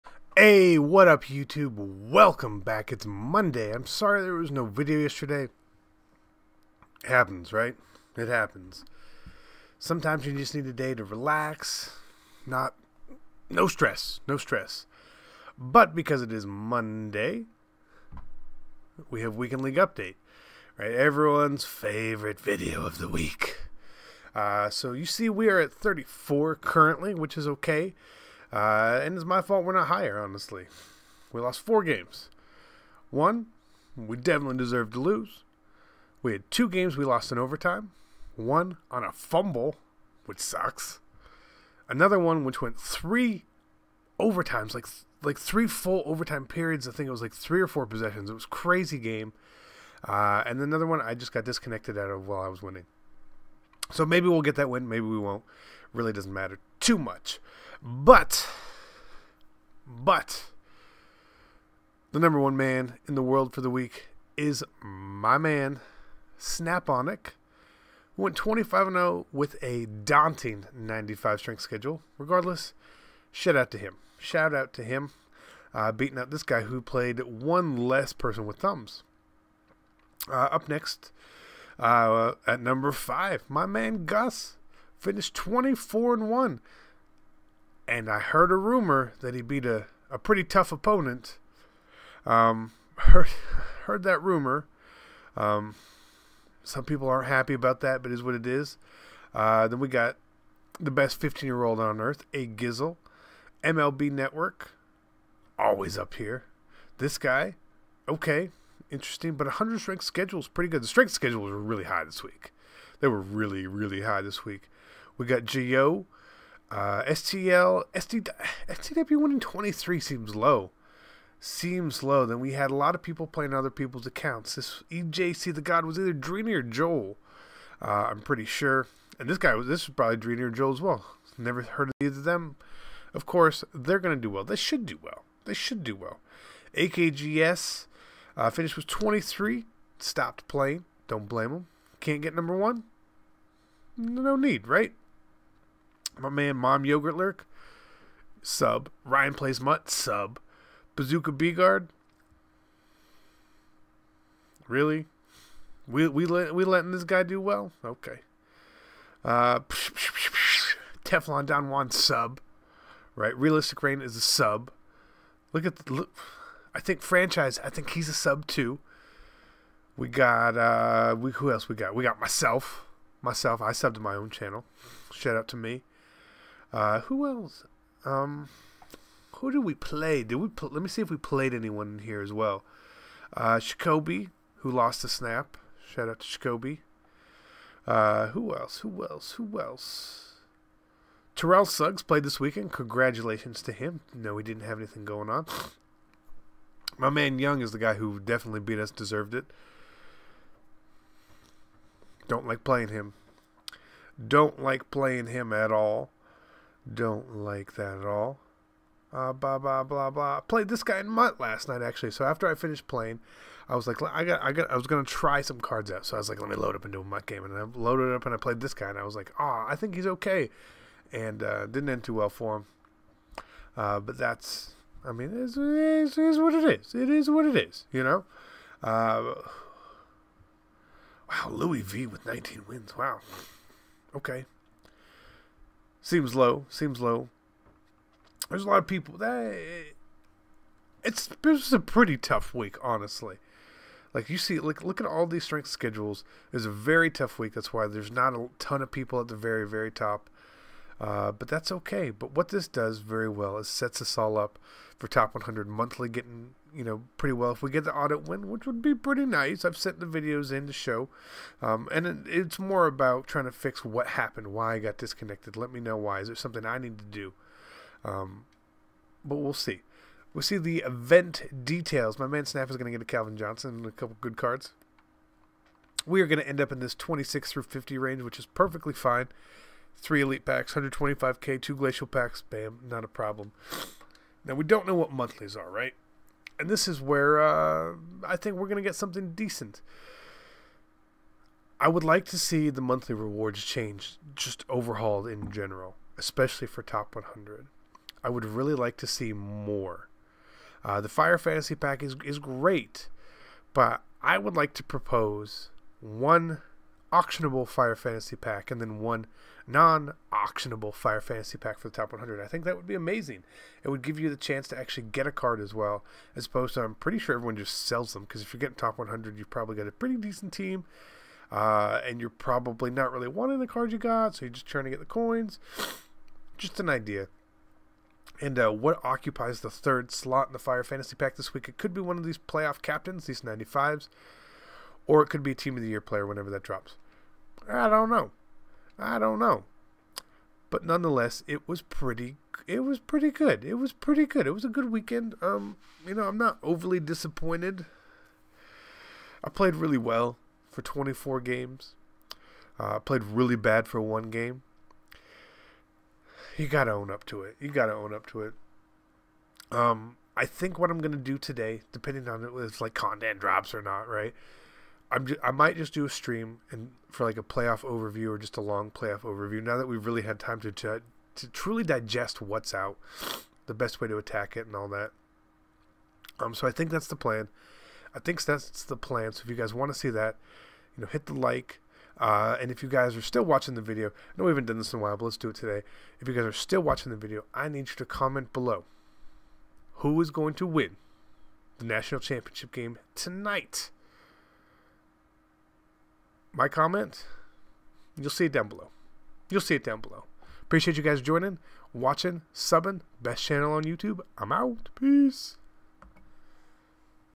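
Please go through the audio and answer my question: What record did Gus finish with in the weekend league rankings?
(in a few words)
24 and 1.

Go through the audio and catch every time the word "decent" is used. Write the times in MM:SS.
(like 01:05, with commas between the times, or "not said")
04:49, 05:20.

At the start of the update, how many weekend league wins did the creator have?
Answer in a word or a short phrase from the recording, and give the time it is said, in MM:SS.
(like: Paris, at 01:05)
34, at 00:25.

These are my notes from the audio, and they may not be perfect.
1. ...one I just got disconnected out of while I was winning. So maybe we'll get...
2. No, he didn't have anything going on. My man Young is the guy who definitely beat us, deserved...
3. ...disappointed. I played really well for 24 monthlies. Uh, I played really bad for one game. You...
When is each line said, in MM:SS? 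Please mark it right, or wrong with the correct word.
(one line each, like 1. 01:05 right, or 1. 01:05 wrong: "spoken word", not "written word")
1. 00:50 right
2. 03:14 right
3. 05:46 wrong: "games", not "monthlies".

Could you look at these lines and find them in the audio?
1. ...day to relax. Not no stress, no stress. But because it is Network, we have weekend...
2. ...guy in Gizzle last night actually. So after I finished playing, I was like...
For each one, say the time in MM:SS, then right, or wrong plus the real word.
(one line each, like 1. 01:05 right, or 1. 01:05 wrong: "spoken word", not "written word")
1. 00:10 wrong: "Monday", not "Network"
2. 03:30 wrong: "MUT", not "Gizzle".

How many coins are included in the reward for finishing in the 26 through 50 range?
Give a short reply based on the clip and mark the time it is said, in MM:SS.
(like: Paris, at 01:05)
125k, at 04:40.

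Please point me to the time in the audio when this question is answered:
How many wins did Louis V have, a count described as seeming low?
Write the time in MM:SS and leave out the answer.
03:52.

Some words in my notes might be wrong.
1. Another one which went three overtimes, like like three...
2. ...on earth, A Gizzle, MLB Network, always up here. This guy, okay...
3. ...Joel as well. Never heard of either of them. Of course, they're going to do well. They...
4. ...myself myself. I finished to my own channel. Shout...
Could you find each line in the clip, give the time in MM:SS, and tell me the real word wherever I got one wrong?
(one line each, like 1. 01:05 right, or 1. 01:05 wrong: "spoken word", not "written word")
1. 00:41 right
2. 01:41 right
3. 02:10 right
4. 02:52 wrong: "subbed", not "finished".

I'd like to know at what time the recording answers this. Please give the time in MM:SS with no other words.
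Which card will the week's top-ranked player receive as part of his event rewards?
04:33.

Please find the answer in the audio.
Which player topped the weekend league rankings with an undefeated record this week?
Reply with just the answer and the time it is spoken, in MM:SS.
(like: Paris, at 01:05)
Snaponic, at 01:06.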